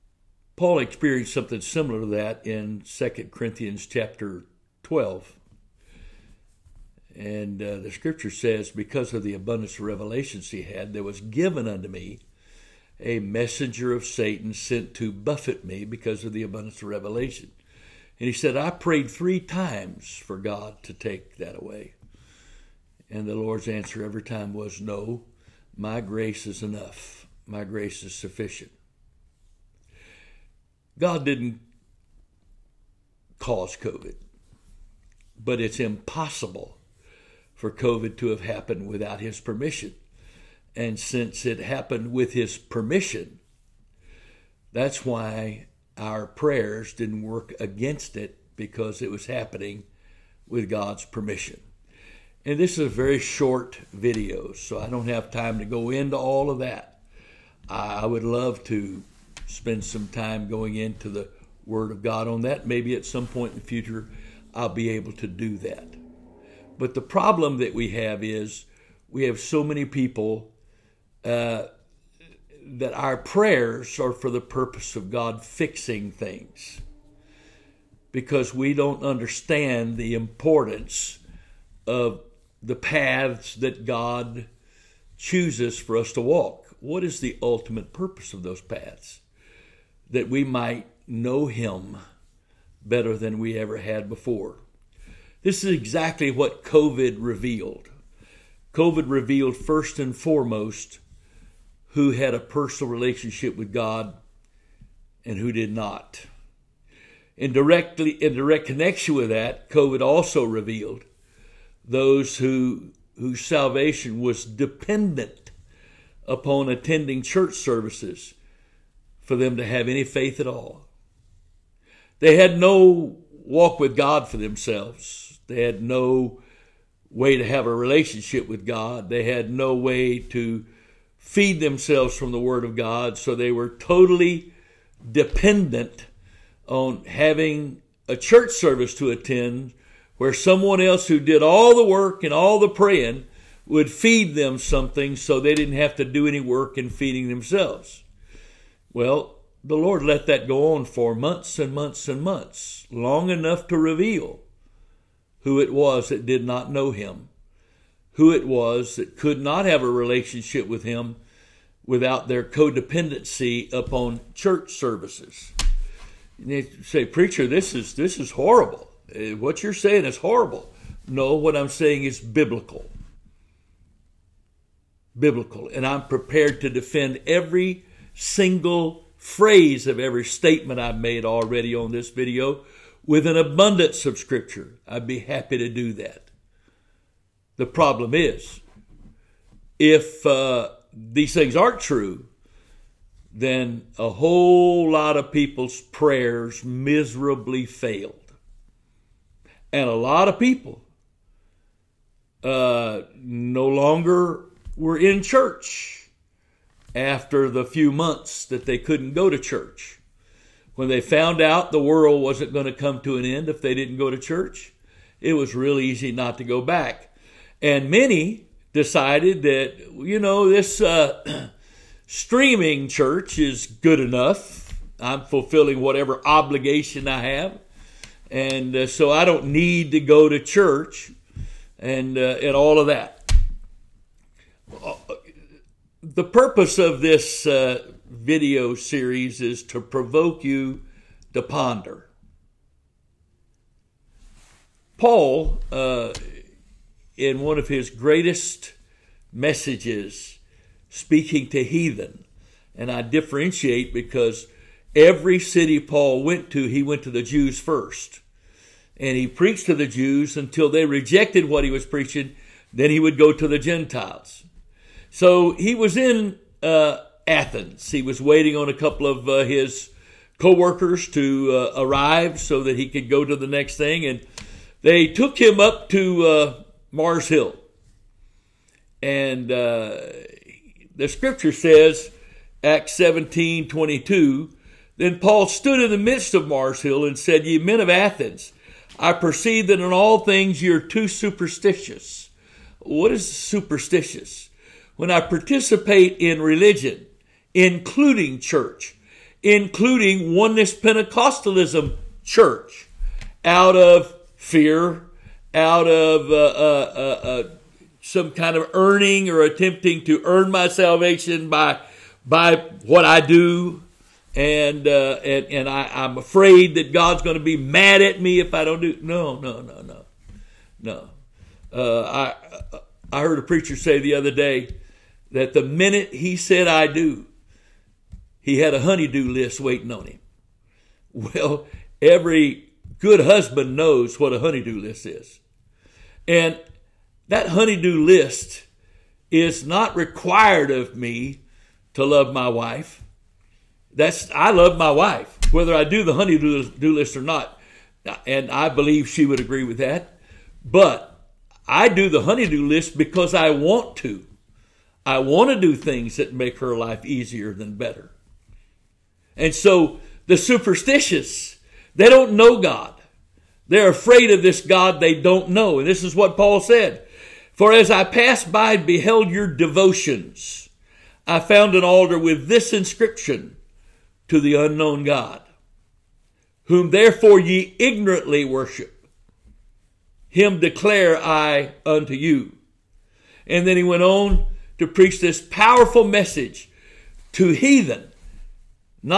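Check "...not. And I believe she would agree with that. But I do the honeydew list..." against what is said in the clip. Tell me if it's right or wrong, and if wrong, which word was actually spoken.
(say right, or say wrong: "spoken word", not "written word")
right.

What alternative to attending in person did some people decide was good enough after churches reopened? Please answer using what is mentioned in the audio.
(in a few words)
Streaming church.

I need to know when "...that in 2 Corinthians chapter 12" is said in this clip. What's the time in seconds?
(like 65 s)
2 s.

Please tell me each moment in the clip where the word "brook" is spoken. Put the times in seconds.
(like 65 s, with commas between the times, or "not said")
not said.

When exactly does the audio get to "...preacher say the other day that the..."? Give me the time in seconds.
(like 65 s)
323 s.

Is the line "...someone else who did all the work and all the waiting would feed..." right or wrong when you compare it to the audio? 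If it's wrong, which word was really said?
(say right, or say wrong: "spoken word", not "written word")
wrong: "praying", not "waiting".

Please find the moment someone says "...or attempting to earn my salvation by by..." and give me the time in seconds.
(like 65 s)
309 s.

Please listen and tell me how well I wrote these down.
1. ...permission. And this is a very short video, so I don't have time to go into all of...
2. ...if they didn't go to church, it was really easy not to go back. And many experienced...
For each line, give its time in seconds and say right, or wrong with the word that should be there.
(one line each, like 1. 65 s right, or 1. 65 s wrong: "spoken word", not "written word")
1. 51 s right
2. 213 s wrong: "decided", not "experienced".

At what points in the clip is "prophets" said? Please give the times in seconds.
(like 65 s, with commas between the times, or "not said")
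not said.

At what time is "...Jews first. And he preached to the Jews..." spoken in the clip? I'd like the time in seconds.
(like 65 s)
257 s.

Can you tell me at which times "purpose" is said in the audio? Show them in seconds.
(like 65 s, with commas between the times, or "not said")
74 s, 87 s, 236 s.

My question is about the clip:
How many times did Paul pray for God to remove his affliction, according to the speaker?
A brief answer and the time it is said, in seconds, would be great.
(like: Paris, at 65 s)
3, at 19 s.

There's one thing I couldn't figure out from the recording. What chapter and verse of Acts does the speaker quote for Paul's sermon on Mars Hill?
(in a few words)
Acts 17:22.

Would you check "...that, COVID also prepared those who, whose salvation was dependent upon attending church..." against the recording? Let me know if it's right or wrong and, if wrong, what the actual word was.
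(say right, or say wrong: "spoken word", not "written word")
wrong: "revealed", not "prepared".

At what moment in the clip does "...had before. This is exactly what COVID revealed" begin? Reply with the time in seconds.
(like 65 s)
93 s.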